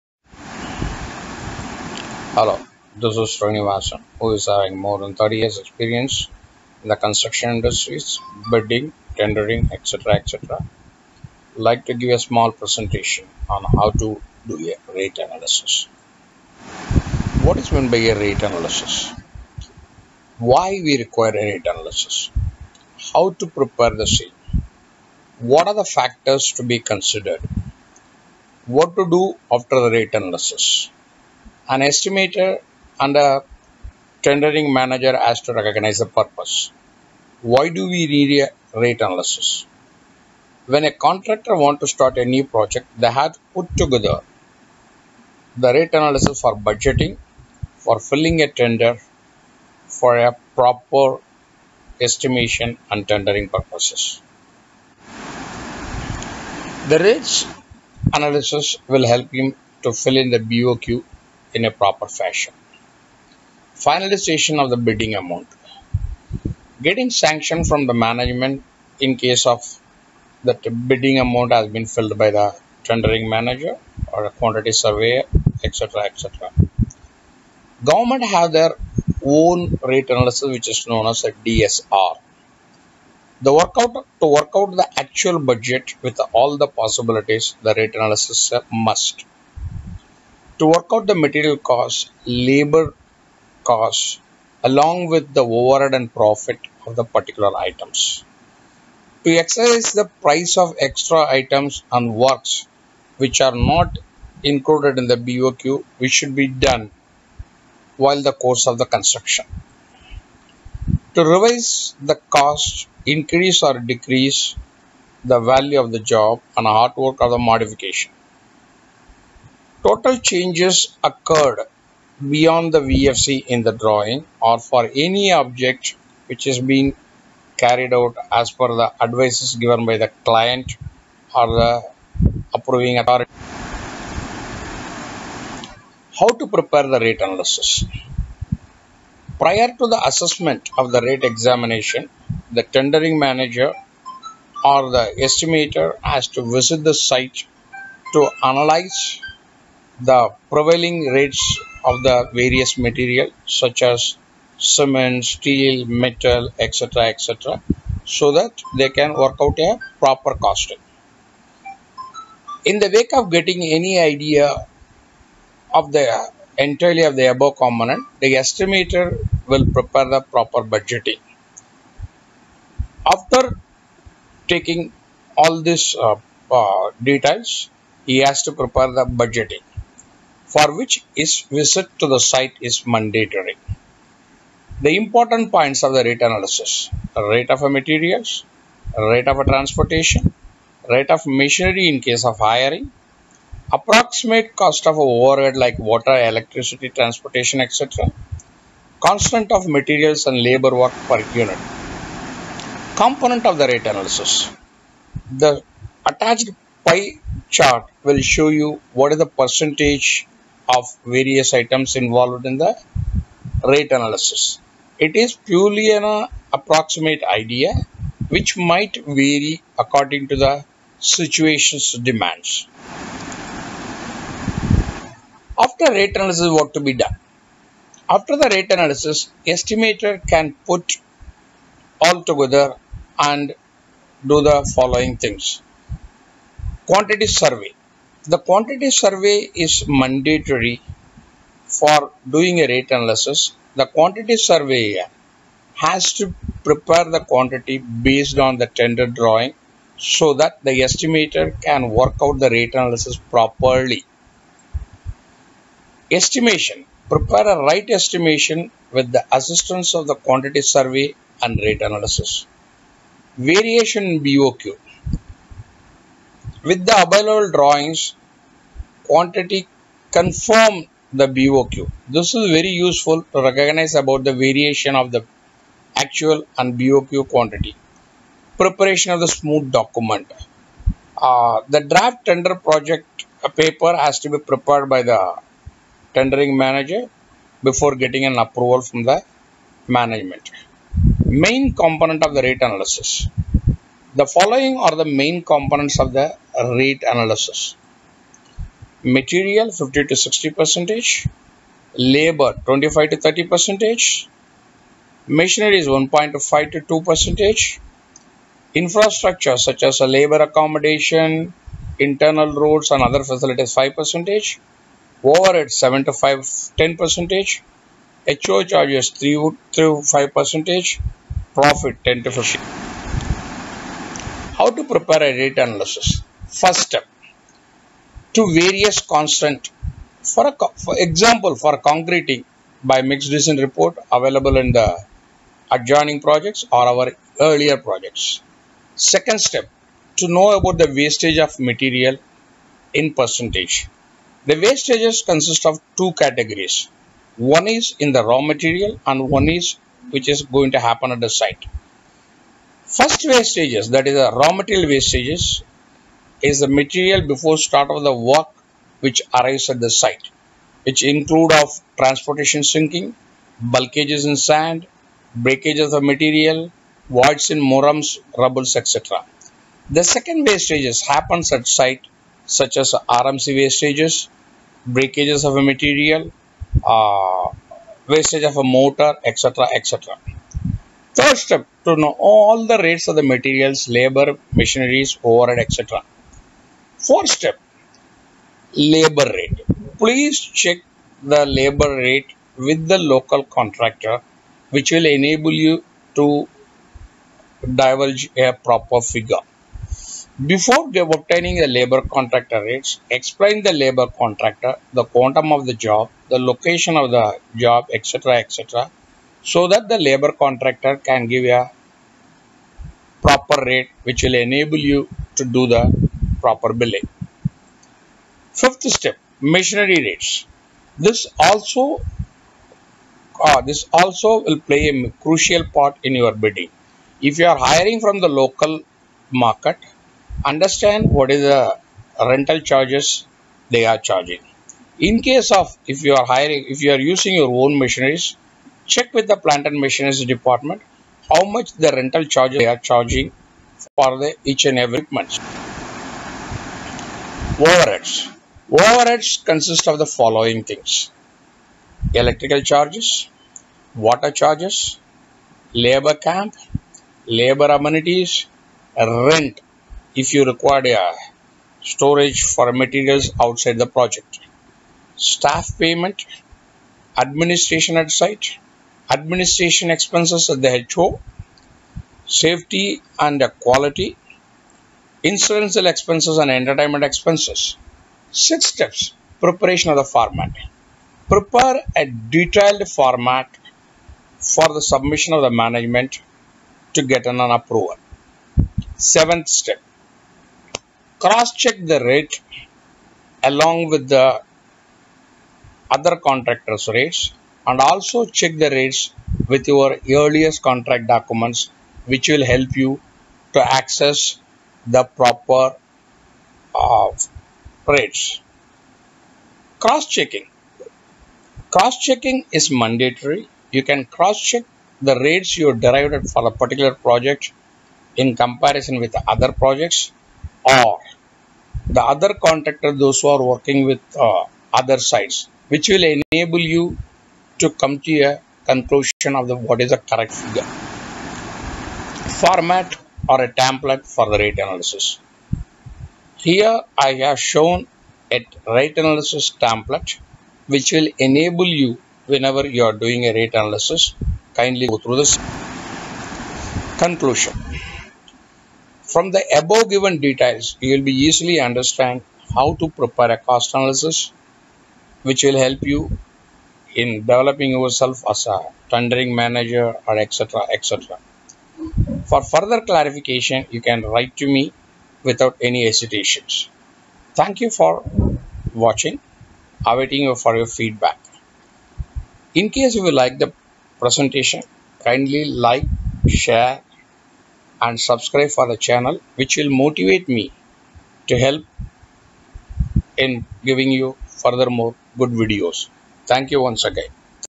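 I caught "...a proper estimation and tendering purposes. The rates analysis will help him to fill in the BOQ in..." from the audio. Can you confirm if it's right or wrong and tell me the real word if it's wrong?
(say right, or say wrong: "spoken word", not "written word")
right.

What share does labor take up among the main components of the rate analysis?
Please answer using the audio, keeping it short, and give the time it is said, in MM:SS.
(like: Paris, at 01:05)
25 to 30 percent, at 05:01.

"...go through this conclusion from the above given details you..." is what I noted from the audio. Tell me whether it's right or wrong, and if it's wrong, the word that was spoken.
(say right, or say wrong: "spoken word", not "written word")
right.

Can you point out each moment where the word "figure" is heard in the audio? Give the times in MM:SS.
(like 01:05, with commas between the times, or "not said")
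06:39, 08:50.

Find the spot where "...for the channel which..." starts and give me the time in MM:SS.
09:38.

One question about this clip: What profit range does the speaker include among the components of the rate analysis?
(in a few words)
10 to 15 percent.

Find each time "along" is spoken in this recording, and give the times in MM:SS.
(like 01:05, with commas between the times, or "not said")
01:34, 08:13.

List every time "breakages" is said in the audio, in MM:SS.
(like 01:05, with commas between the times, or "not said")
06:05, 06:14.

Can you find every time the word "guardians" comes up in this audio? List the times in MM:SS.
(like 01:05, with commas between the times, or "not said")
not said.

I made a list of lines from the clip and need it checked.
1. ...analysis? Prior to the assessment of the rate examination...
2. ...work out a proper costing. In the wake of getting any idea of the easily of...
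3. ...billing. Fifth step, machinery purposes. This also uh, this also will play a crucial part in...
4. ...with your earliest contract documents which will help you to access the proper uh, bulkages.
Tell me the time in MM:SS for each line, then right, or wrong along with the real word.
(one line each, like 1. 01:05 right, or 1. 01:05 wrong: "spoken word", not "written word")
1. 02:17 right
2. 02:39 wrong: "entirely", not "easily"
3. 06:56 wrong: "rates", not "purposes"
4. 08:19 wrong: "rates", not "bulkages".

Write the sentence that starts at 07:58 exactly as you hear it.
Six steps preparation of the format.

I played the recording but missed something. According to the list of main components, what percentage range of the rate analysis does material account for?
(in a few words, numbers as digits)
50 to 60 percent.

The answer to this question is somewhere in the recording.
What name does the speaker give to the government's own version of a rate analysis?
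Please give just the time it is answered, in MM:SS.
01:21.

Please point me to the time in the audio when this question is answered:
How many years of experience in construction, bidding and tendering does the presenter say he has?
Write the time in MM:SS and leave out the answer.
00:04.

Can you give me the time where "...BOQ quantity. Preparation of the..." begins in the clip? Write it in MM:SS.
04:36.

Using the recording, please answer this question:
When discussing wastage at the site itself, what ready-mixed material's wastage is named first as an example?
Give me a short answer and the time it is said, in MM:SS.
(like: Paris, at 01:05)
RMC, at 06:13.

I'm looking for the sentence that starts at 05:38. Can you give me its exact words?
Second step, to know about the wastage of material in percentage.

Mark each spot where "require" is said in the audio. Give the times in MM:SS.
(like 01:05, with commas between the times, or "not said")
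00:20, 07:40.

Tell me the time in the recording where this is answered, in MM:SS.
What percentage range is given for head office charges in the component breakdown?
05:18.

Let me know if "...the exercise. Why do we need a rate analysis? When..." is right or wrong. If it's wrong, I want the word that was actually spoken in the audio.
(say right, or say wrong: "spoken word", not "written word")
wrong: "purpose", not "exercise".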